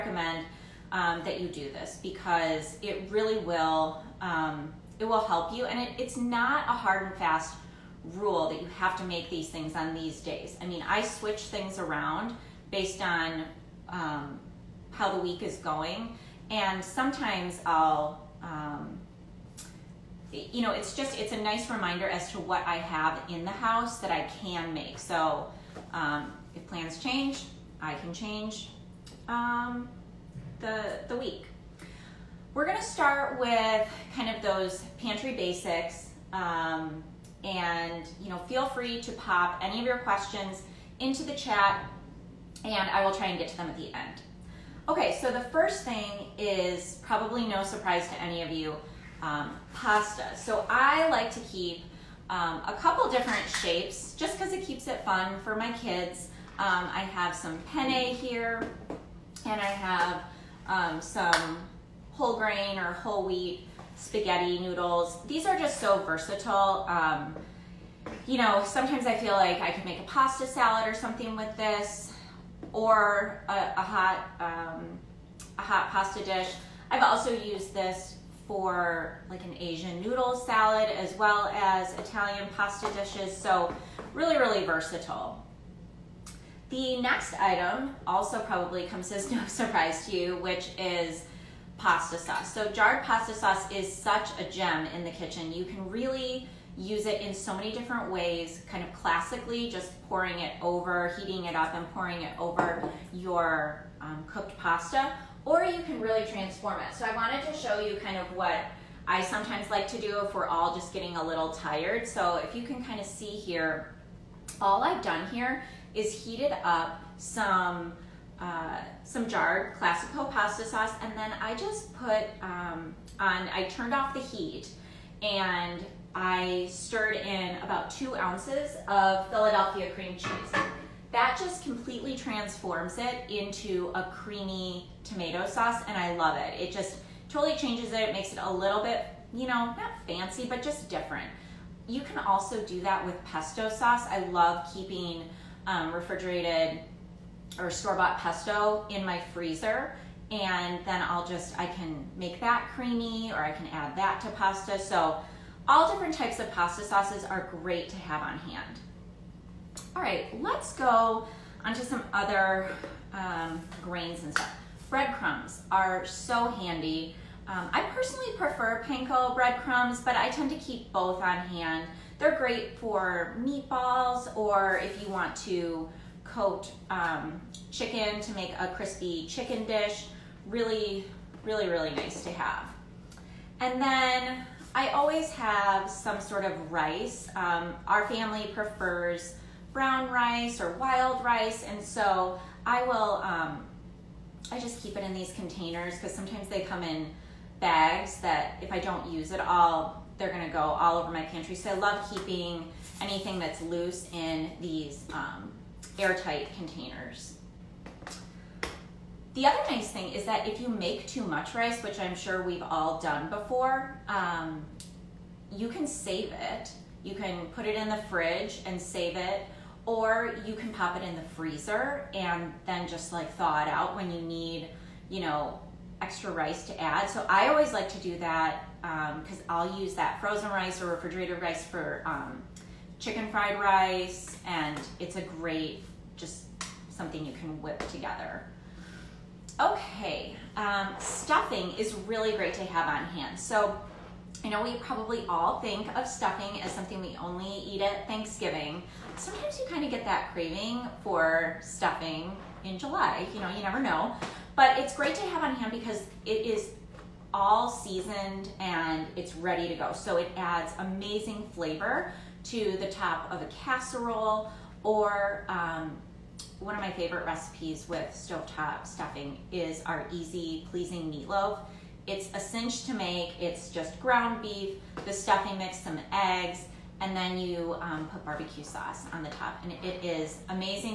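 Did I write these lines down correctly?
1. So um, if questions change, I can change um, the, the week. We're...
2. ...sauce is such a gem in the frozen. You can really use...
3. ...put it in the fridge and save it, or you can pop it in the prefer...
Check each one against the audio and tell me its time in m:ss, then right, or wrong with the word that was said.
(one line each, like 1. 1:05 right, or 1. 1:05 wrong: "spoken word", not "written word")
1. 0:24 wrong: "plans", not "questions"
2. 1:33 wrong: "kitchen", not "frozen"
3. 3:37 wrong: "freezer", not "prefer".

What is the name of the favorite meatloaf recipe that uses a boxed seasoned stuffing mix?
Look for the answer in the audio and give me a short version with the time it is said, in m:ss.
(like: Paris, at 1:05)
easy pleasing meatloaf, at 4:30.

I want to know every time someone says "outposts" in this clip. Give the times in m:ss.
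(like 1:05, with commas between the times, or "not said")
not said.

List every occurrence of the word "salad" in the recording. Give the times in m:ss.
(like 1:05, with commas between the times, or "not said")
1:10, 1:20.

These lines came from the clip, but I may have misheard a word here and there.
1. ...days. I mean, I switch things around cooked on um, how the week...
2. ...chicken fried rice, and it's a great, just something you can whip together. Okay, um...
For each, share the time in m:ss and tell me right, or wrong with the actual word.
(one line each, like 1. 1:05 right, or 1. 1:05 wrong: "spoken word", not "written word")
1. 0:10 wrong: "based", not "cooked"
2. 3:52 right.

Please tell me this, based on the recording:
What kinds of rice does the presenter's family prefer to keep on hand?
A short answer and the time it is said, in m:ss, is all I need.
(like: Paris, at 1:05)
brown rice or wild rice, at 3:09.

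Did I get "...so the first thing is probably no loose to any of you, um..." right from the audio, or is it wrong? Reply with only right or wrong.
wrong.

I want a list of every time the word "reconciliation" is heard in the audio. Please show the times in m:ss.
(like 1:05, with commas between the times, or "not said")
not said.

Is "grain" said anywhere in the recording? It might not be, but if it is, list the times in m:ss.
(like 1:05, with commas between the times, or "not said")
1:02, 2:43.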